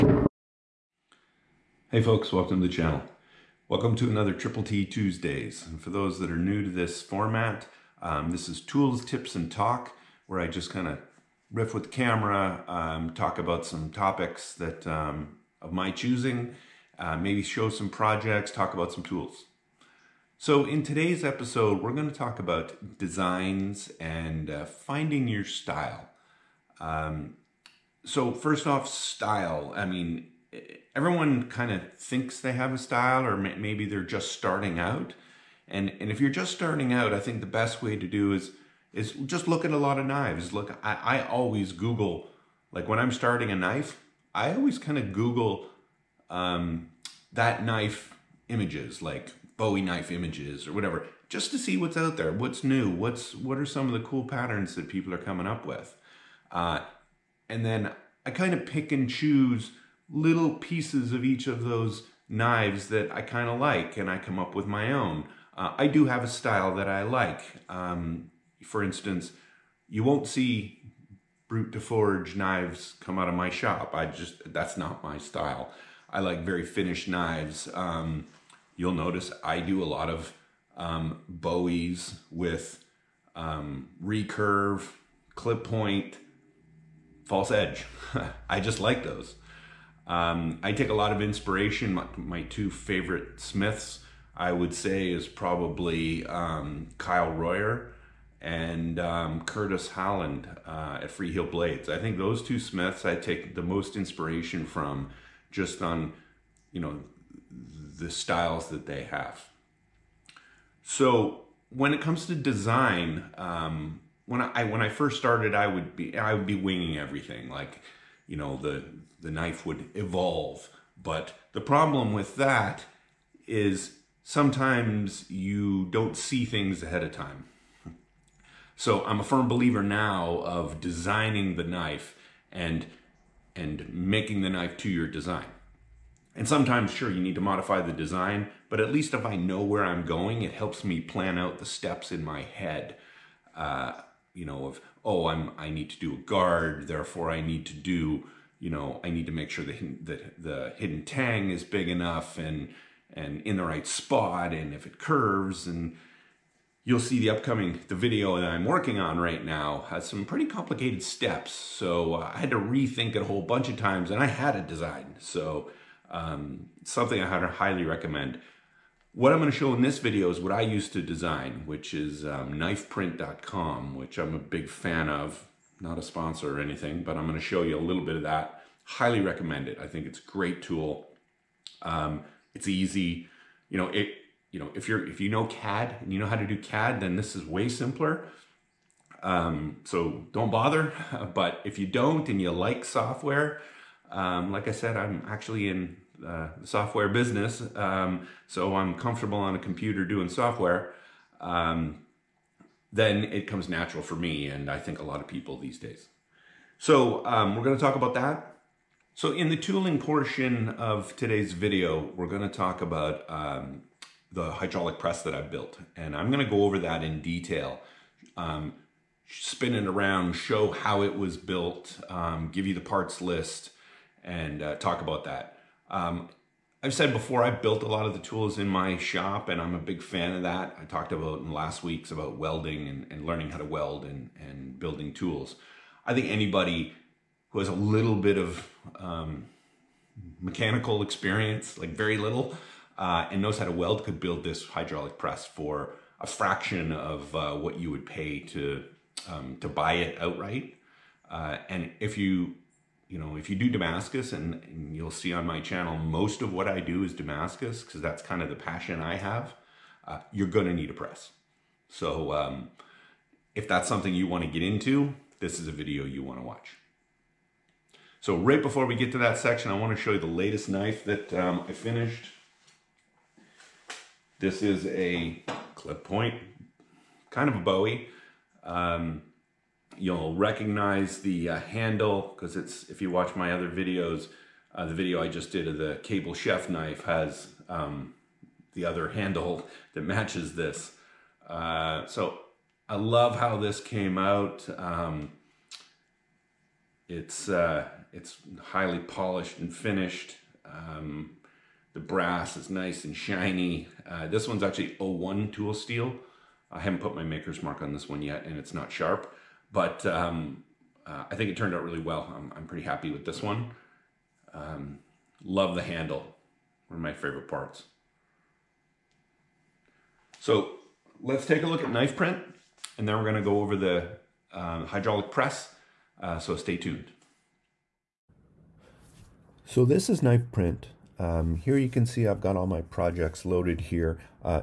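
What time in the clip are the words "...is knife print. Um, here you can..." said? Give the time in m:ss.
5:30.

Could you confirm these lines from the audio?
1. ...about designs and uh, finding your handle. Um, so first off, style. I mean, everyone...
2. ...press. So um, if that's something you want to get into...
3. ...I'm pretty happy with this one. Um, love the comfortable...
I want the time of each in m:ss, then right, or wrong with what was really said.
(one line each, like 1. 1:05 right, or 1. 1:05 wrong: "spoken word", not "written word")
1. 0:22 wrong: "style", not "handle"
2. 4:20 right
3. 5:12 wrong: "handle", not "comfortable".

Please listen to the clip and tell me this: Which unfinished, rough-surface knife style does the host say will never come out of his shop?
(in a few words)
brut de forge.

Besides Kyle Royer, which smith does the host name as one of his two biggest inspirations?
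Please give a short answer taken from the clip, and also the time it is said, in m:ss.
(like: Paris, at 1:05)
Curtis Holland, at 1:39.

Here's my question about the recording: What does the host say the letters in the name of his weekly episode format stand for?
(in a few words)
Tools, Tips, and Talk.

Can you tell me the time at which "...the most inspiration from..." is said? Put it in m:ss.
1:43.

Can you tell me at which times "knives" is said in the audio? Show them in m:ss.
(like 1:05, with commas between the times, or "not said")
0:40, 1:02, 1:12, 1:17.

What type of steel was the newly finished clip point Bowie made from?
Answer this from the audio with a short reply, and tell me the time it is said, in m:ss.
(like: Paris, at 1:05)
O1 tool steel, at 5:04.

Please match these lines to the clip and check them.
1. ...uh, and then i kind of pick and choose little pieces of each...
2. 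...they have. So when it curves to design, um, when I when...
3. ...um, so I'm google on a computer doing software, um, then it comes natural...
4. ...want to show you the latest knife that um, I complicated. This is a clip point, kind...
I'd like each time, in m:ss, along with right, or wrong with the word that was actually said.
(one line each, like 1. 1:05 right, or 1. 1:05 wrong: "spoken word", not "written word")
1. 0:56 right
2. 1:48 wrong: "comes", not "curves"
3. 3:17 wrong: "comfortable", not "google"
4. 4:29 wrong: "finished", not "complicated".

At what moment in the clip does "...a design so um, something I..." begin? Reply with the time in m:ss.
2:44.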